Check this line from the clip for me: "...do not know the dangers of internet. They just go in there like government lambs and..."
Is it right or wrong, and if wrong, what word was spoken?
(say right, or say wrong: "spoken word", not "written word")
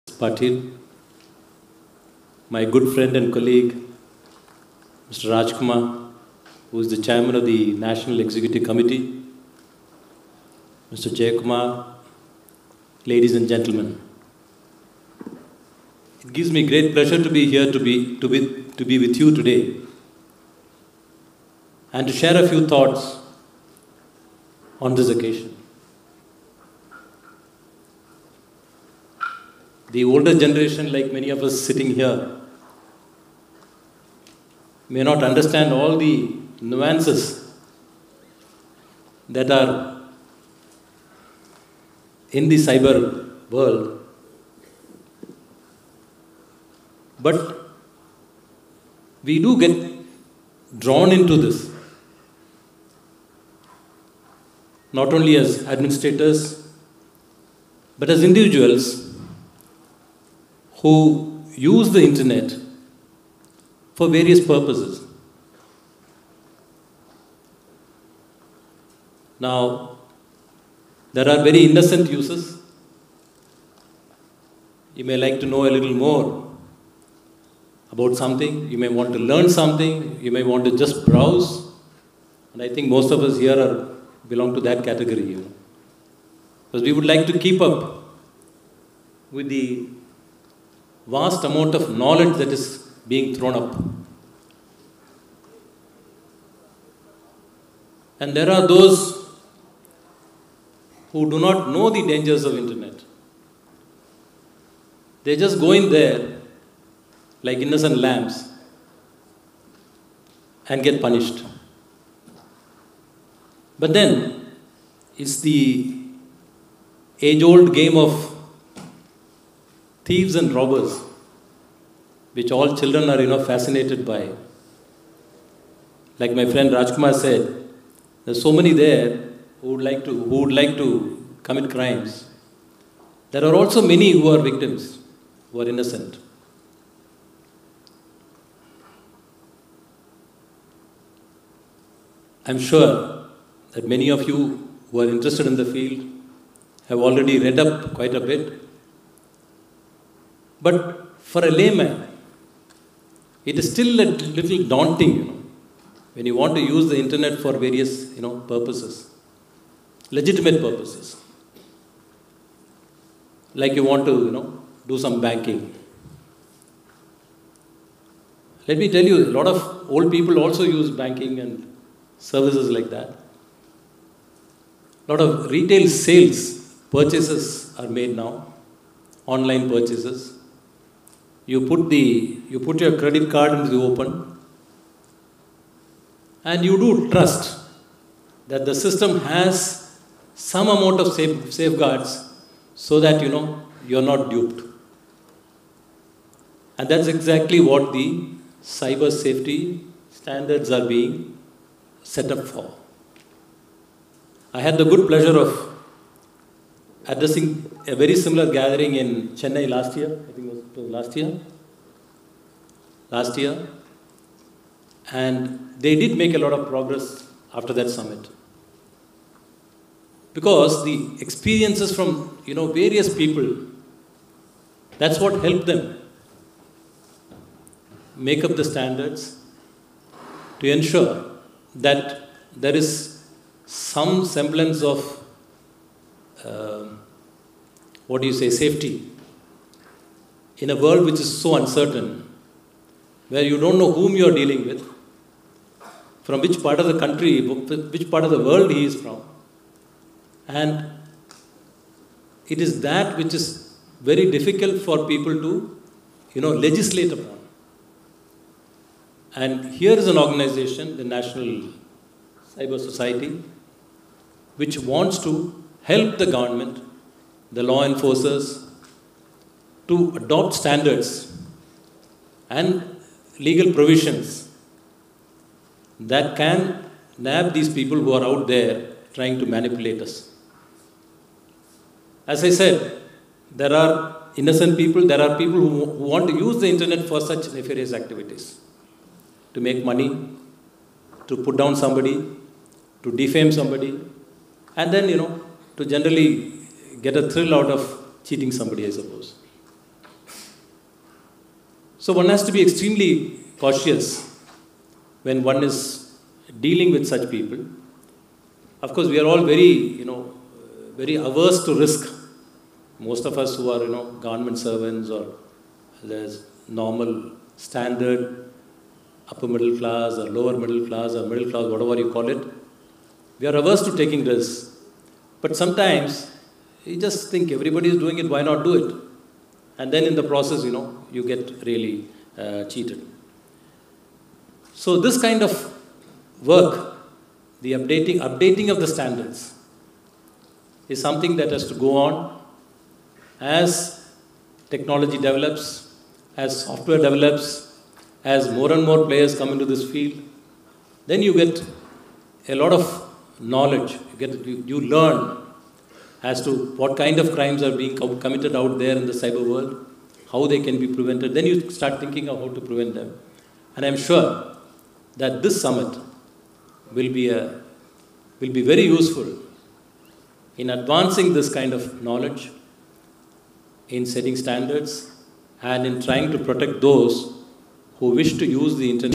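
wrong: "innocent", not "government".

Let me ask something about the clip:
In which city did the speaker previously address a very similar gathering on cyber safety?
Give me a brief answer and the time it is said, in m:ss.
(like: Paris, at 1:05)
Chennai, at 3:29.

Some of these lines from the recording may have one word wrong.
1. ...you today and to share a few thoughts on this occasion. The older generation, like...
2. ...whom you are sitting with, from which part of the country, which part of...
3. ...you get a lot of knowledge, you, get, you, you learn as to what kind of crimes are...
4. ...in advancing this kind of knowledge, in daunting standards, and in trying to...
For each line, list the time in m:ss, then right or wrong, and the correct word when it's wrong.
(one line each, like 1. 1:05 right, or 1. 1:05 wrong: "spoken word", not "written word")
1. 0:19 right
2. 4:03 wrong: "dealing", not "sitting"
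3. 5:51 right
4. 6:10 wrong: "setting", not "daunting".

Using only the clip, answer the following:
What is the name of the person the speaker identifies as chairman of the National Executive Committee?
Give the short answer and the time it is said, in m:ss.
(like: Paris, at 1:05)
Mr. Jayakumar, at 0:10.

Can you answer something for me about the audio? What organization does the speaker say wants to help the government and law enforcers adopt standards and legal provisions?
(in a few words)
National Cyber Society.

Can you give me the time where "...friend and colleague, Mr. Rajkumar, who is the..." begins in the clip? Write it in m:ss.
0:02.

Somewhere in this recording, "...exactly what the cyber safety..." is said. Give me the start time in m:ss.
3:17.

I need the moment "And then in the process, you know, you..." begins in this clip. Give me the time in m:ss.
5:29.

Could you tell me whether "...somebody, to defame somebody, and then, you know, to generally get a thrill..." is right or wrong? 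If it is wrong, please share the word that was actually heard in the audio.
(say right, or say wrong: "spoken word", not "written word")
right.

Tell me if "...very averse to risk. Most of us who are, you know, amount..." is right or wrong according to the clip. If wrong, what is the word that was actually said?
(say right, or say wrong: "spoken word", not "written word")
wrong: "government", not "amount".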